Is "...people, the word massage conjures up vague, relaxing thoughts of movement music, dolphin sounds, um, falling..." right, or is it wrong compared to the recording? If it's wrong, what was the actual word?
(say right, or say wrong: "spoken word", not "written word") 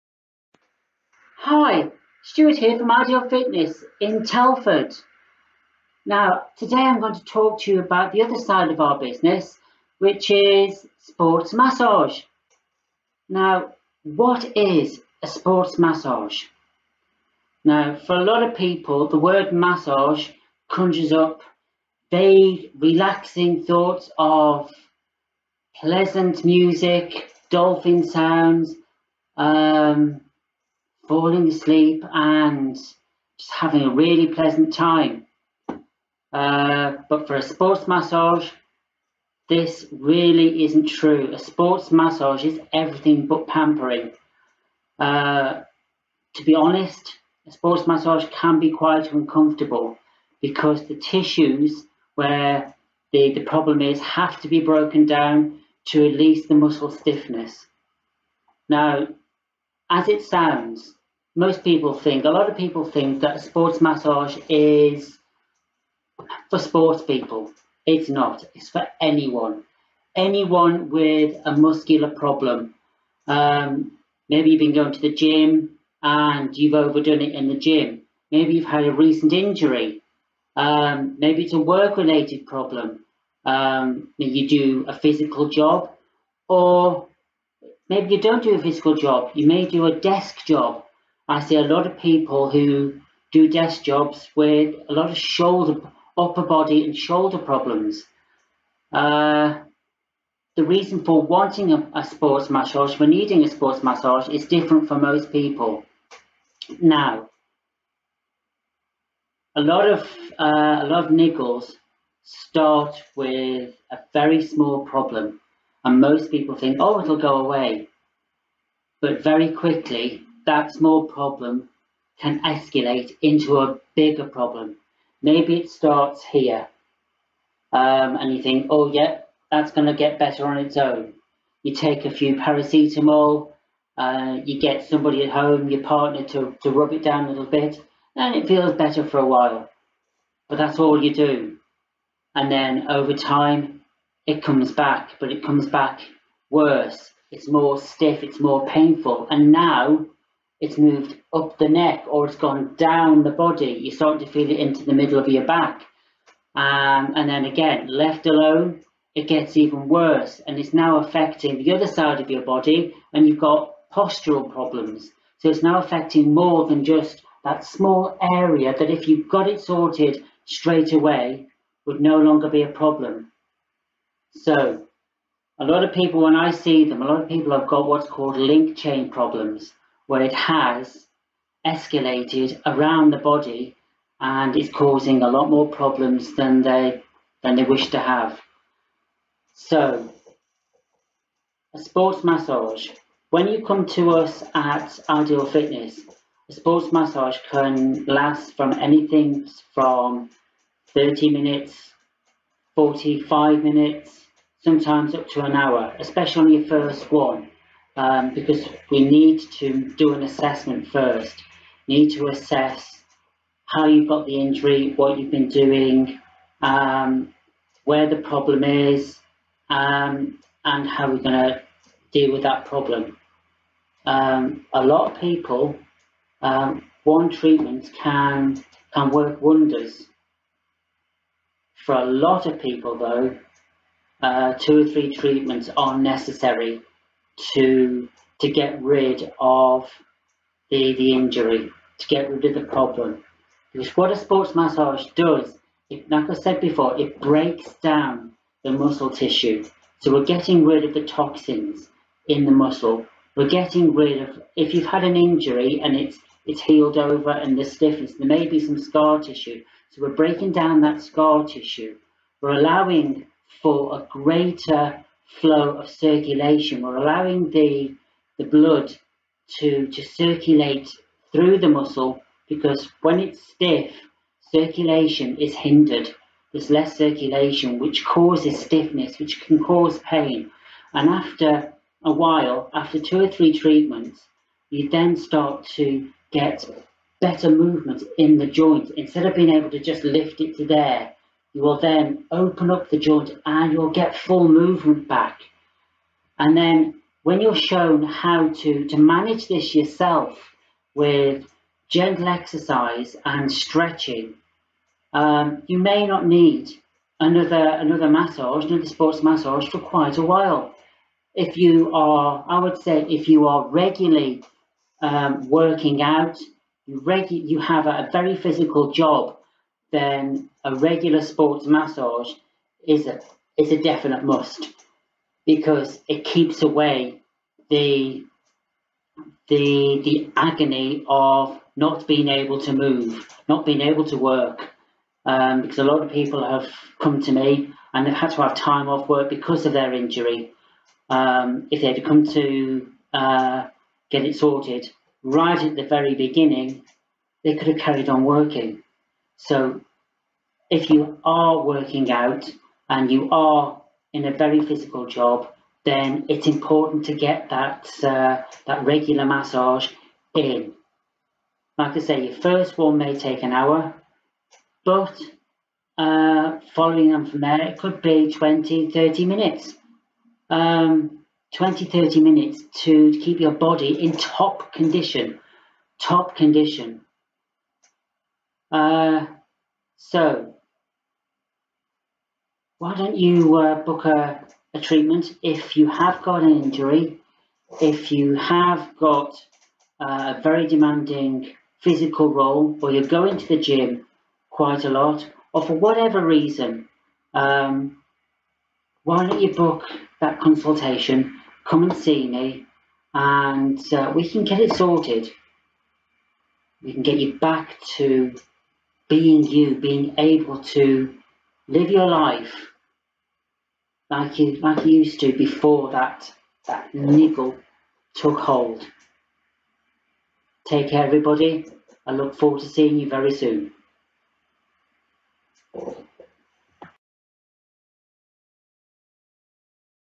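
wrong: "pleasant", not "movement".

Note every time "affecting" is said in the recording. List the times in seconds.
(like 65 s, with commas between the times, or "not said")
160 s, 165 s.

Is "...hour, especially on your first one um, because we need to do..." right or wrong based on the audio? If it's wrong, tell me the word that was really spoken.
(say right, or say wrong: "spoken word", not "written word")
right.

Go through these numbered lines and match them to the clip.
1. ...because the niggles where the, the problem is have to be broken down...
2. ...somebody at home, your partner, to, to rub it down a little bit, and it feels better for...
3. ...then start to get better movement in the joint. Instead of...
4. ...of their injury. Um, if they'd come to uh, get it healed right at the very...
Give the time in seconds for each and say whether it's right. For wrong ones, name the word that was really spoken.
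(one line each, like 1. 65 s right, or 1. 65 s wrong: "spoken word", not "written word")
1. 50 s wrong: "tissues", not "niggles"
2. 134 s right
3. 284 s right
4. 339 s wrong: "sorted", not "healed".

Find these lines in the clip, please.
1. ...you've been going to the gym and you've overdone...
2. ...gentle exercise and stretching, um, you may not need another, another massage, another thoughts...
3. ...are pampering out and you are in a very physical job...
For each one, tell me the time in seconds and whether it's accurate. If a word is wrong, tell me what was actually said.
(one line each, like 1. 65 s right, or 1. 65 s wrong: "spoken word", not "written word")
1. 74 s right
2. 301 s wrong: "sports", not "thoughts"
3. 351 s wrong: "working", not "pampering".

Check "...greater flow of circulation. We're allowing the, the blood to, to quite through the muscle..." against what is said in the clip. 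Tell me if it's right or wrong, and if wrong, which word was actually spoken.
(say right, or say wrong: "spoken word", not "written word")
wrong: "circulate", not "quite".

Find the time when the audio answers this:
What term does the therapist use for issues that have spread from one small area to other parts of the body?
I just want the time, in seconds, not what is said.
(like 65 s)
178 s.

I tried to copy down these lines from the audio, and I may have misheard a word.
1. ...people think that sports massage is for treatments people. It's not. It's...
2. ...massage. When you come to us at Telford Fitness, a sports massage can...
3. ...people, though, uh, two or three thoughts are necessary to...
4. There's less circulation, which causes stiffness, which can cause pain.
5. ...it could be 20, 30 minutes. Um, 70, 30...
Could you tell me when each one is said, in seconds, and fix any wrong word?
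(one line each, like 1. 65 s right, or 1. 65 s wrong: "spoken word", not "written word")
1. 62 s wrong: "sports", not "treatments"
2. 192 s wrong: "Ideal", not "Telford"
3. 232 s wrong: "treatments", not "thoughts"
4. 276 s right
5. 367 s wrong: "20", not "70".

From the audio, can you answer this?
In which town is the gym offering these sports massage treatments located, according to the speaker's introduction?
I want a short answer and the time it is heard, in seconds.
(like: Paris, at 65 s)
Telford, at 4 s.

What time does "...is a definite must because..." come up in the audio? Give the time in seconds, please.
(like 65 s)
323 s.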